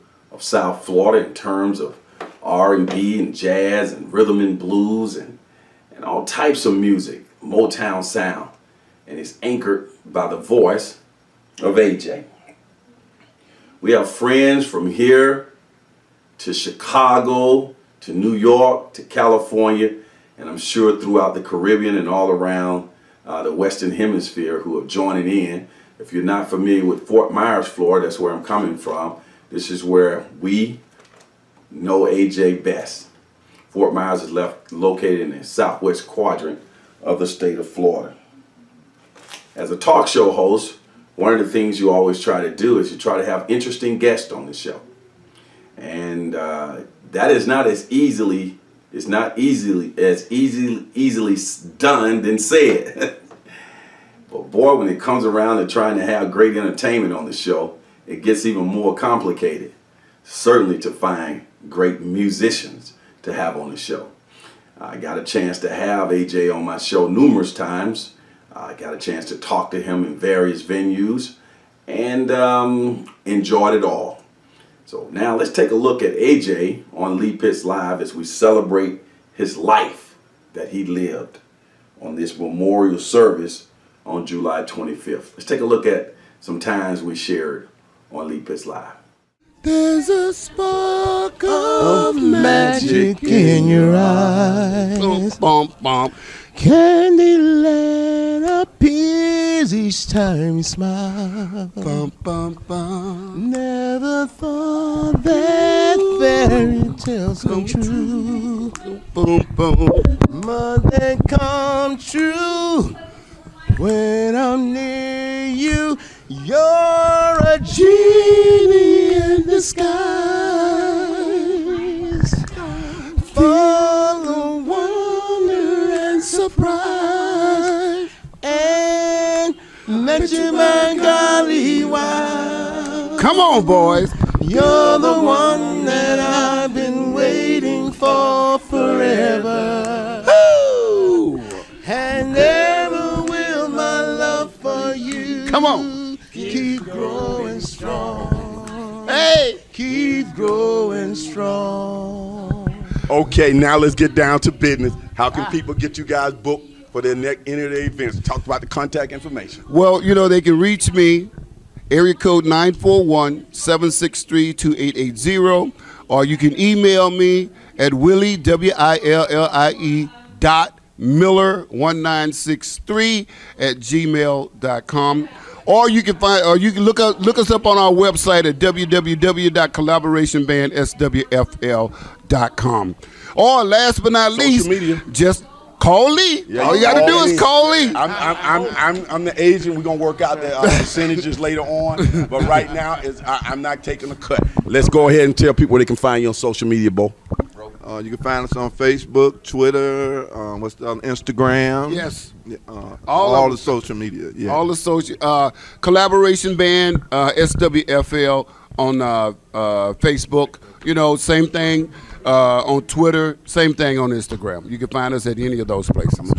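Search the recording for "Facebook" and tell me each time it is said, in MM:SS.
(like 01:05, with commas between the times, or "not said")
03:18, 03:29.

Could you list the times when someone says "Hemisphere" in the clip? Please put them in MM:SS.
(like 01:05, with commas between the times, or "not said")
00:23.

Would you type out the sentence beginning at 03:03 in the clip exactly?
Or last but not Social least, media.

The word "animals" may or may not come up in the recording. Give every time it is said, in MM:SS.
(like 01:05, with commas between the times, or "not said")
not said.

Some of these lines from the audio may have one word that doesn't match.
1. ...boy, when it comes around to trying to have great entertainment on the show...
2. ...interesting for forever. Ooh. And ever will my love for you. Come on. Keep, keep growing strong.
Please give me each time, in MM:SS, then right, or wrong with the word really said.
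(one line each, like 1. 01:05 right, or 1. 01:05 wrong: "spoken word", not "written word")
1. 00:54 right
2. 02:17 wrong: "waiting", not "interesting".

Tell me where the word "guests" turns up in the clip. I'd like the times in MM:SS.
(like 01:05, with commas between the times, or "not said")
00:43.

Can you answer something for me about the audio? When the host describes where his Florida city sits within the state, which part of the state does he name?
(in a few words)
southwest quadrant.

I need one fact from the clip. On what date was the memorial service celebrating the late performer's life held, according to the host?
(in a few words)
July 25th.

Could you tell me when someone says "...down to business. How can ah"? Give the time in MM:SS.
02:34.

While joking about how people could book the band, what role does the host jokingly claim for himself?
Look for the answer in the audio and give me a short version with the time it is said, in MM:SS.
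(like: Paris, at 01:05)
the agent, at 03:09.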